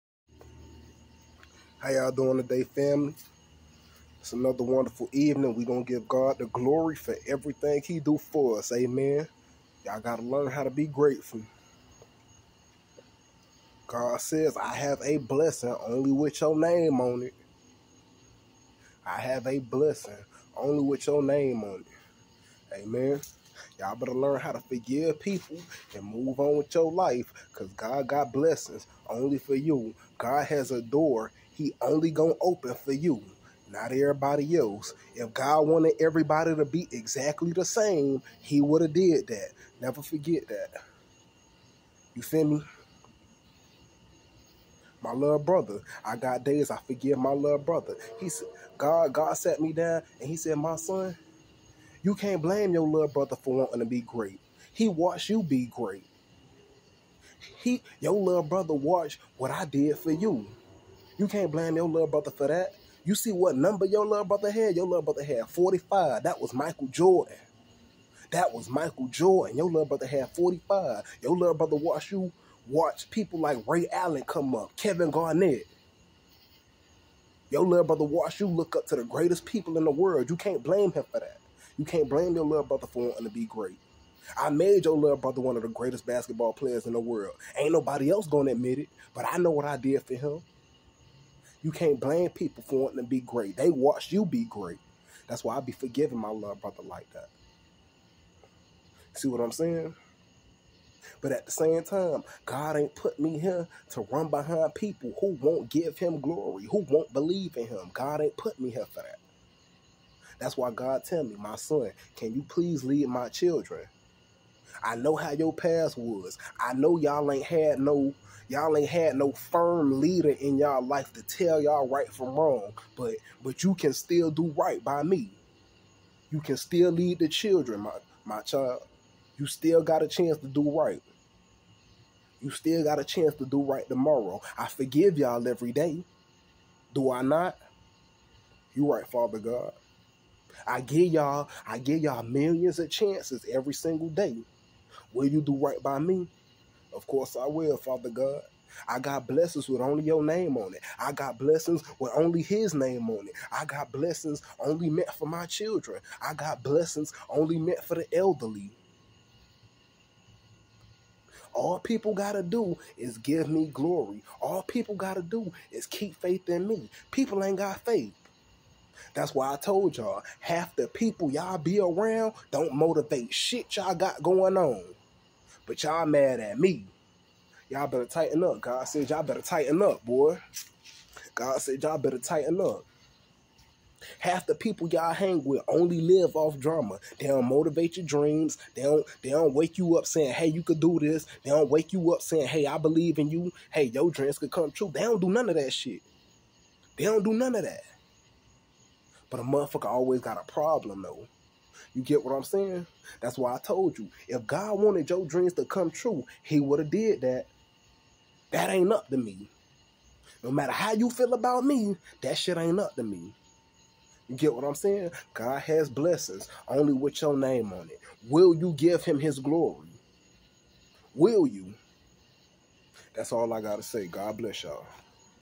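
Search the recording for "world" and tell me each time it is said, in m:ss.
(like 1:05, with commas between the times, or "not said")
1:19, 1:26.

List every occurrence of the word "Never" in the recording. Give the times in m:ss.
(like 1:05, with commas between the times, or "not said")
0:39.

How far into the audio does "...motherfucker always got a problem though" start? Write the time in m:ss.
3:19.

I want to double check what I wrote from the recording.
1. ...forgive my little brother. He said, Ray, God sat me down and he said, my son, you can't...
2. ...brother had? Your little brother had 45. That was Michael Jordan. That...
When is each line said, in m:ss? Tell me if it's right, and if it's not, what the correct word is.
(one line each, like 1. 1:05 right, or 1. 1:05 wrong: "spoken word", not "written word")
1. 0:46 wrong: "God", not "Ray"
2. 1:04 right.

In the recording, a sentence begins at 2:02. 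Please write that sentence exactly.
But but you can still do right by me.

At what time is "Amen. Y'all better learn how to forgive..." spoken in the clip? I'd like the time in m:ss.
0:22.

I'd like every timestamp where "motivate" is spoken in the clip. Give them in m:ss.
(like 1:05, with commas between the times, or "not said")
2:52, 3:07.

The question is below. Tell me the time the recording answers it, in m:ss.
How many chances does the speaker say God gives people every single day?
2:22.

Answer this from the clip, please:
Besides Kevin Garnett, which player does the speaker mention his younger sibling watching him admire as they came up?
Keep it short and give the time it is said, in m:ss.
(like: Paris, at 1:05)
Ray Allen, at 1:13.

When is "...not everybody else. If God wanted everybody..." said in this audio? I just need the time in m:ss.
0:33.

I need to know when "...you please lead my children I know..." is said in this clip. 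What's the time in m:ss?
1:52.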